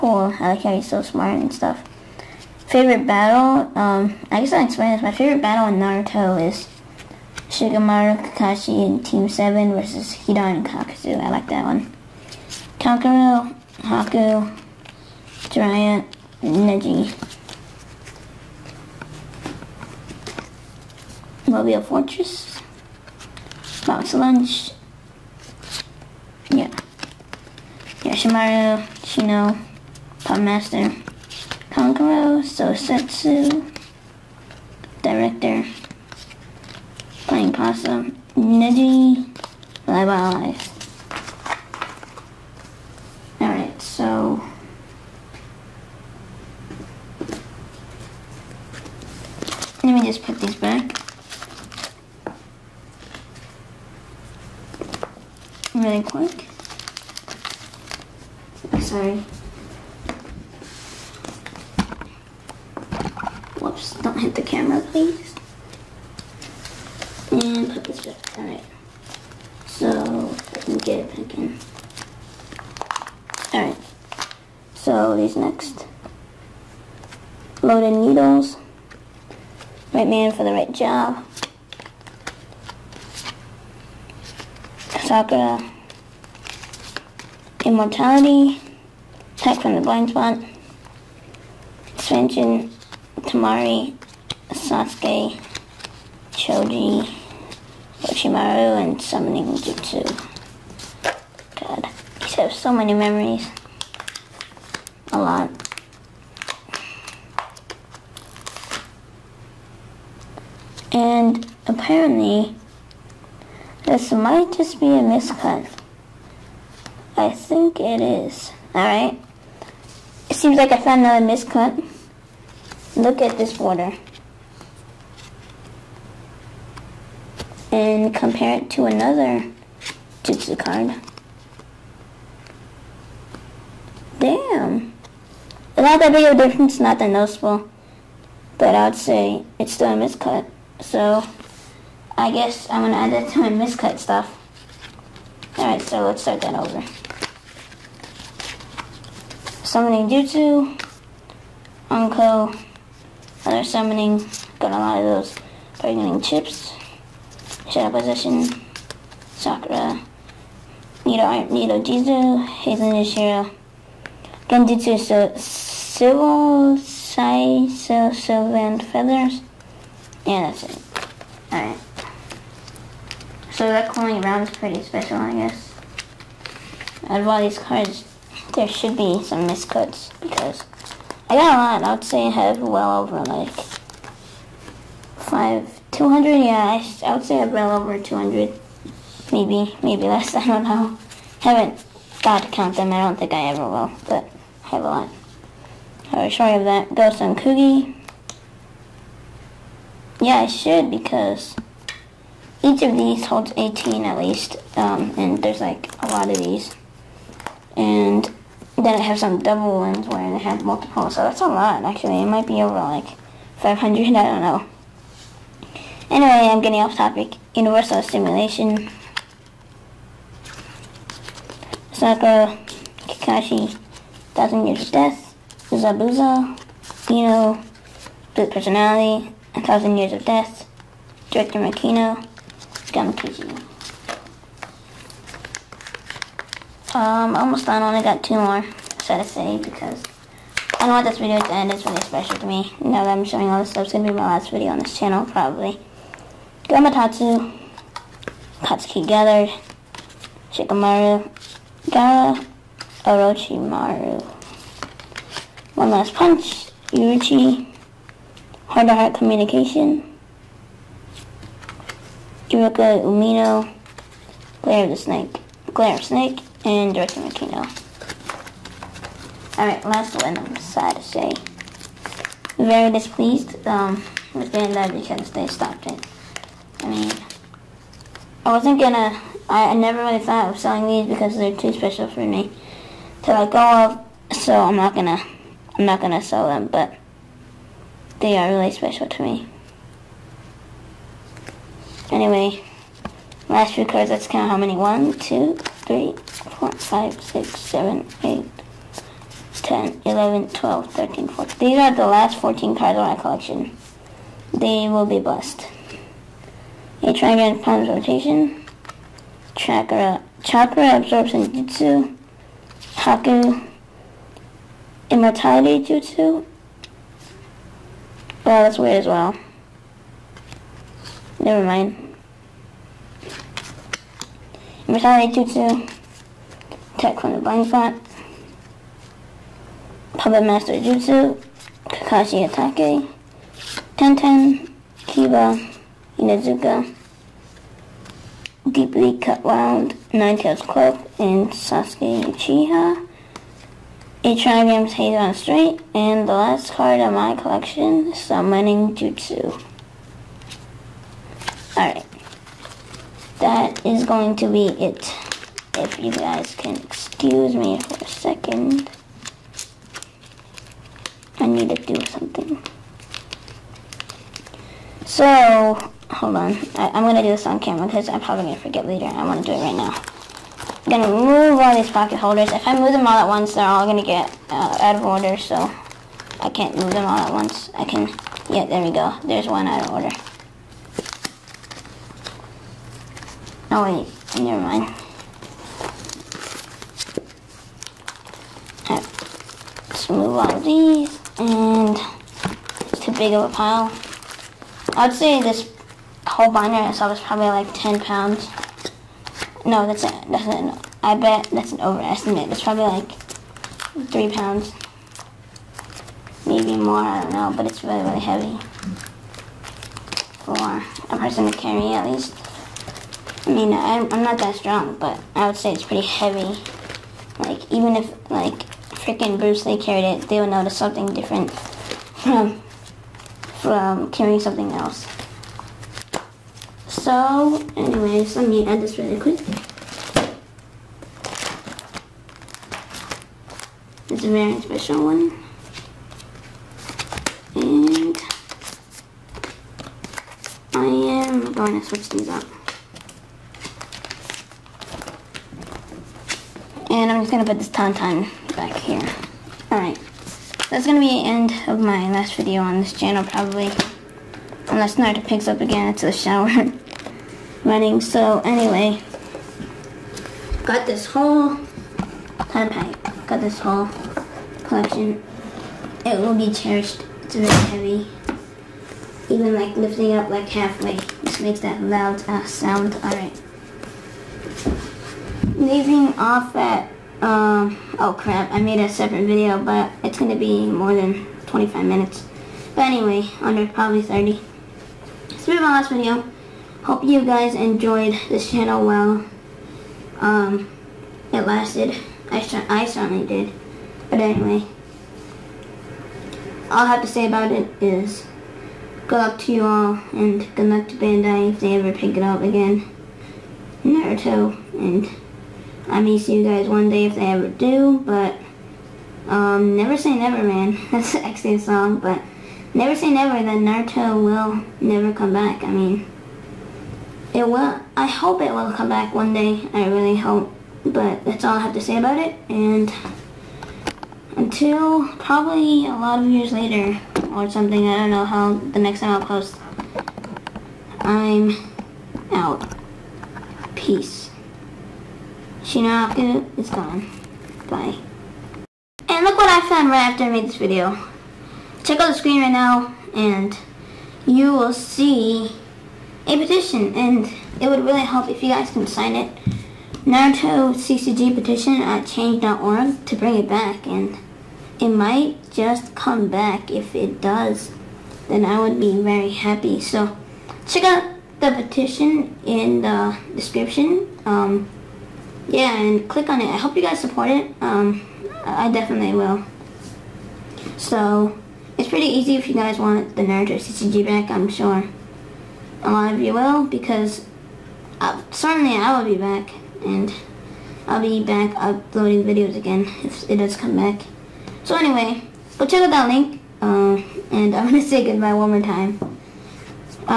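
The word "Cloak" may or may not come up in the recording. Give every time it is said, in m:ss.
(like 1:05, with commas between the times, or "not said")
5:40.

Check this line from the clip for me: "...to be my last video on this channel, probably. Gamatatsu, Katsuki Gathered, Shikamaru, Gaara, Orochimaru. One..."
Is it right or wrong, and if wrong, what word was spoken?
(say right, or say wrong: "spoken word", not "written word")
right.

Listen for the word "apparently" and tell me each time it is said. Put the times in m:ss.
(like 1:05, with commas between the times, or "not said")
1:51.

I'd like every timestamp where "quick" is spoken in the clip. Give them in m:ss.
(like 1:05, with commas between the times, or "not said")
0:56, 7:09.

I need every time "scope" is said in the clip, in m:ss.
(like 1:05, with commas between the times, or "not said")
not said.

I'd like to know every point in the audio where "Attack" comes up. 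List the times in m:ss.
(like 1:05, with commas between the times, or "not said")
1:29, 5:26.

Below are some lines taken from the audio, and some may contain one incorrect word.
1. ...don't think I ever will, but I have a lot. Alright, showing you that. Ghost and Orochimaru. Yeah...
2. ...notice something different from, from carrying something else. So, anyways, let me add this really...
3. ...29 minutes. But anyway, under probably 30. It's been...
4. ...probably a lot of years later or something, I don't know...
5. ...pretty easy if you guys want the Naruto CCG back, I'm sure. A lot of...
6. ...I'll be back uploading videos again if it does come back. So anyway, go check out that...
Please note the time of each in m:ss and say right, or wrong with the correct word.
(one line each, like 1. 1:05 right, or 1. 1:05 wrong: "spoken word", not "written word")
1. 3:13 wrong: "Coogie", not "Orochimaru"
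2. 7:00 right
3. 8:01 wrong: "25", not "29"
4. 8:45 right
5. 9:31 right
6. 9:40 right.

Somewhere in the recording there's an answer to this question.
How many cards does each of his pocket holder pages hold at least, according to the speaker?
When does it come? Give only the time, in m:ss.
3:23.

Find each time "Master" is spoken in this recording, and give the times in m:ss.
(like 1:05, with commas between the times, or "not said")
0:30, 5:30.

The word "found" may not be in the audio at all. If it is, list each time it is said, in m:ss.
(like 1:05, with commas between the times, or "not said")
2:00, 8:59.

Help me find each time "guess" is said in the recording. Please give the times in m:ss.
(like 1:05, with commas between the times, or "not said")
0:04, 2:22, 2:55.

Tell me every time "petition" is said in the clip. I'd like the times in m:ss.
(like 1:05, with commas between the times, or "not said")
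9:06, 9:11, 9:21.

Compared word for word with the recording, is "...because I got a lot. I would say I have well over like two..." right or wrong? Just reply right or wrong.
wrong.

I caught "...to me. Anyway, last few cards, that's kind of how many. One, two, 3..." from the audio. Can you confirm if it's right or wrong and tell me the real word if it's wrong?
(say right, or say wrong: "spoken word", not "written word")
right.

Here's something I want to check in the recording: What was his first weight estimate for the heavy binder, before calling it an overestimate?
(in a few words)
10 pounds.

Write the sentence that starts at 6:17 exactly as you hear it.
I can, yeah, there we go.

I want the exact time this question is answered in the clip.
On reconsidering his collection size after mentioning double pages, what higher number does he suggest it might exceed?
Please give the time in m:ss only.
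3:32.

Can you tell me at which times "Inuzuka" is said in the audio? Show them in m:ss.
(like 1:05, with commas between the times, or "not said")
5:36.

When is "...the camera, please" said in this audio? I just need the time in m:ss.
1:04.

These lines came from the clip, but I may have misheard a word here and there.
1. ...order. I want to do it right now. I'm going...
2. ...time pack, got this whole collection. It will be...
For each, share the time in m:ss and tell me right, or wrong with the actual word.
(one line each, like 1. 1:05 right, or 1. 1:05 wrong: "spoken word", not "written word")
1. 6:08 wrong: "later", not "order"
2. 7:42 right.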